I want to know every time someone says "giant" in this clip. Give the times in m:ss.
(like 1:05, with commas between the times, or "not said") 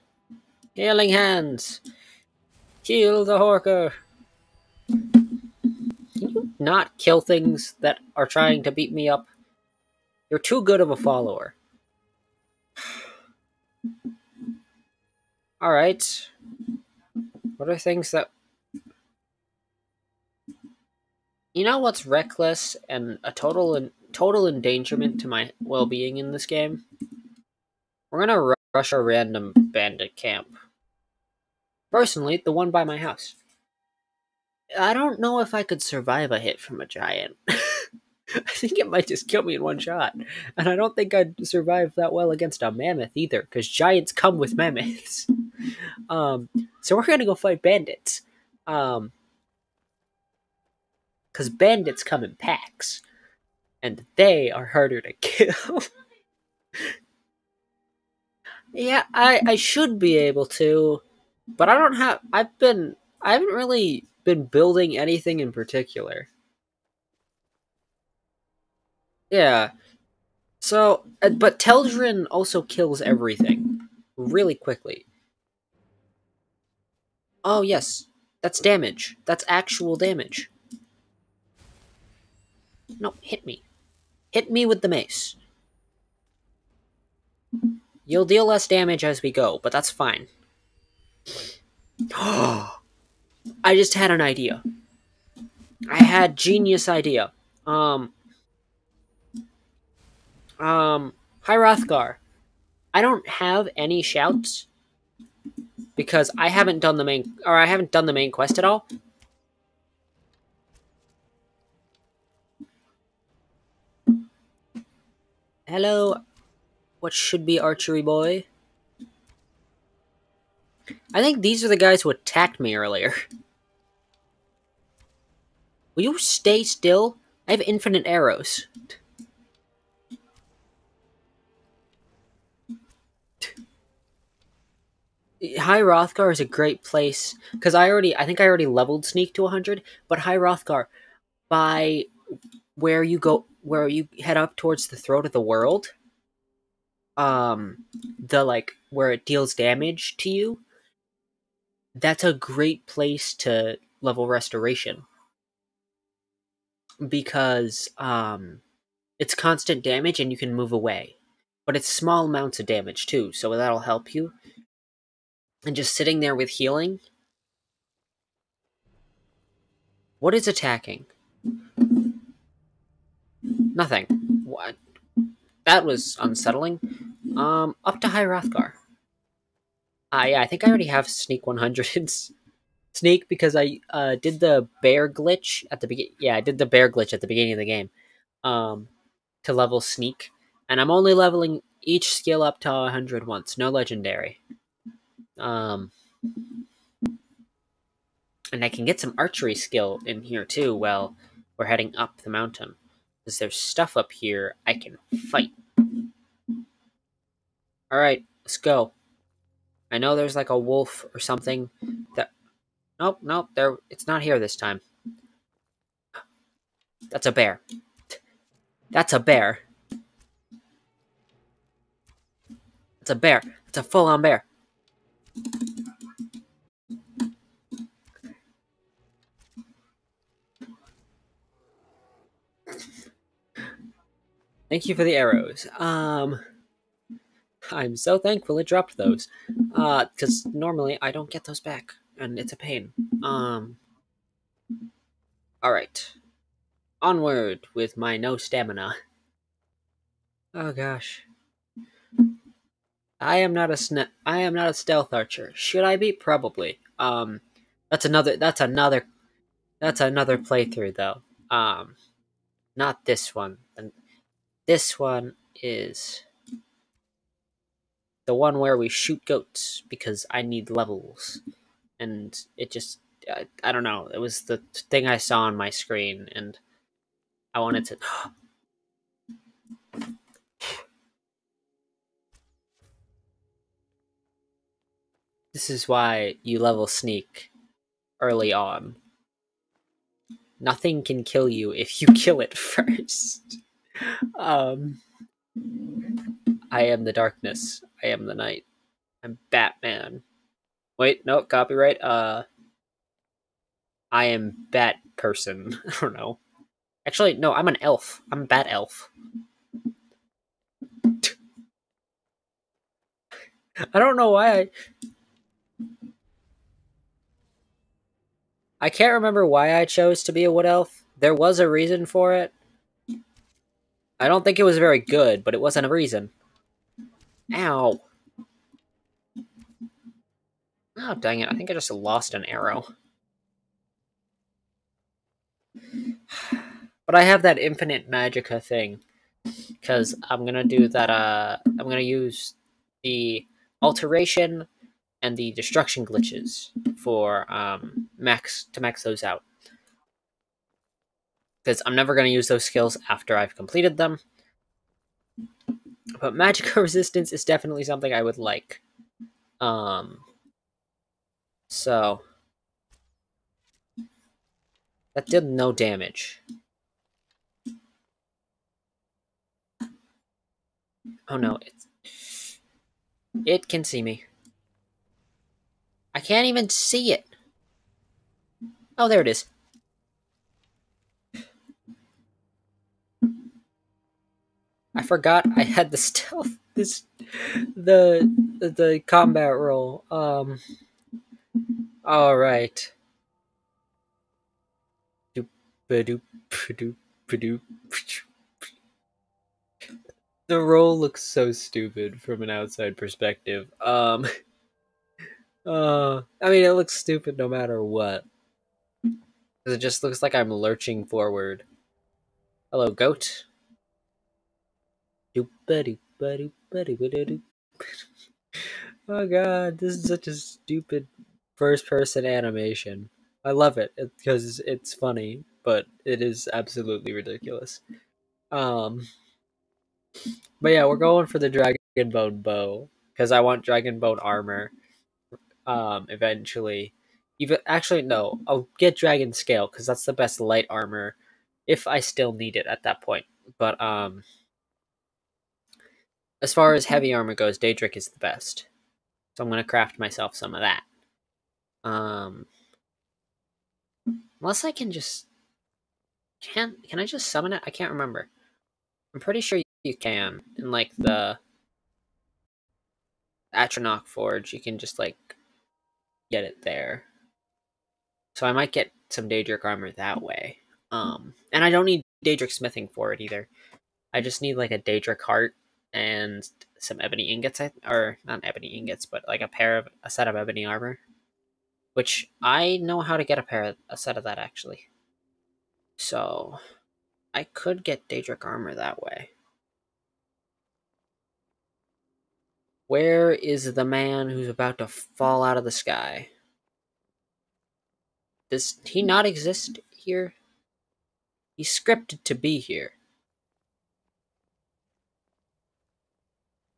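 0:36, 0:43.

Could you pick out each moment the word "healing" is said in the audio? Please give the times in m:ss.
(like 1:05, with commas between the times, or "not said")
0:00, 2:46.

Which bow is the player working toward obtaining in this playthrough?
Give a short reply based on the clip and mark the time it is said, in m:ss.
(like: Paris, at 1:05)
dragon bone bow, at 7:11.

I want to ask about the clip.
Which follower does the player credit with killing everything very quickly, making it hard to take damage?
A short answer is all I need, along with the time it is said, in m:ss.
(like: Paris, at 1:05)
Teldryn, at 1:11.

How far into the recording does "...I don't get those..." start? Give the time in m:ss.
4:01.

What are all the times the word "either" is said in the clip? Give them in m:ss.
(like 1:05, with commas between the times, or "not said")
0:43, 7:53.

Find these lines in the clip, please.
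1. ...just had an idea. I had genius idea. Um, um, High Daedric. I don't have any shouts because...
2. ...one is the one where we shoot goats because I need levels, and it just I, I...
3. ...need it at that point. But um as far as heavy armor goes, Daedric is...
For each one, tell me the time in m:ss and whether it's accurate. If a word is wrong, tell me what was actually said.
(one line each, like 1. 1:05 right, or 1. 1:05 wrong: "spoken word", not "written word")
1. 1:33 wrong: "Hrothgar", not "Daedric"
2. 4:24 right
3. 7:22 right.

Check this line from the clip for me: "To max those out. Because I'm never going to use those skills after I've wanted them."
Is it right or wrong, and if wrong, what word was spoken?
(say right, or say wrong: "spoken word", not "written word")
wrong: "completed", not "wanted".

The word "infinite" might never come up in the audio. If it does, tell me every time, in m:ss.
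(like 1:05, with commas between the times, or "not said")
2:07, 5:37.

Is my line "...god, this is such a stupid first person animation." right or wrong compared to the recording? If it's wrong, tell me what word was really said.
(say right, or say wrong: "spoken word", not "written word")
right.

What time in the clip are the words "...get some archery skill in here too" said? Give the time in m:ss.
3:18.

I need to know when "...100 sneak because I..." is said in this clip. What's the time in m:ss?
3:01.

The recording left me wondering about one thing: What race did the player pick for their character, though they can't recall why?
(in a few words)
wood elf.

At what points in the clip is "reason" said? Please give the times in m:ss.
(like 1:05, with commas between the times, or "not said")
5:21, 5:25.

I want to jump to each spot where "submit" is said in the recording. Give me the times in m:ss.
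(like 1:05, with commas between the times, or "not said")
not said.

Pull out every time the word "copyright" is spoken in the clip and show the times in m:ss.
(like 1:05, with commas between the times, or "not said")
5:01.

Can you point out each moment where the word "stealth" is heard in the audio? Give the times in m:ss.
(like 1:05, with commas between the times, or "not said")
4:14, 6:25.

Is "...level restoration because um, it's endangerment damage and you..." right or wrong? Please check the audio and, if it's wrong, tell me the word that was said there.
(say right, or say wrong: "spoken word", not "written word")
wrong: "constant", not "endangerment".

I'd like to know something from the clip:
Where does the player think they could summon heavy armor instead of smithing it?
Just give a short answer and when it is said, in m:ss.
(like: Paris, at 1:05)
Atronach Forge, at 7:43.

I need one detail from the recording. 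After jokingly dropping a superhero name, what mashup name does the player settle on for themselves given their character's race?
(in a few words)
Bat Elf.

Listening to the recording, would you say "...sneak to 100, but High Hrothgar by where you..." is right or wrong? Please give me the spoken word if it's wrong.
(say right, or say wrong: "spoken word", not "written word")
right.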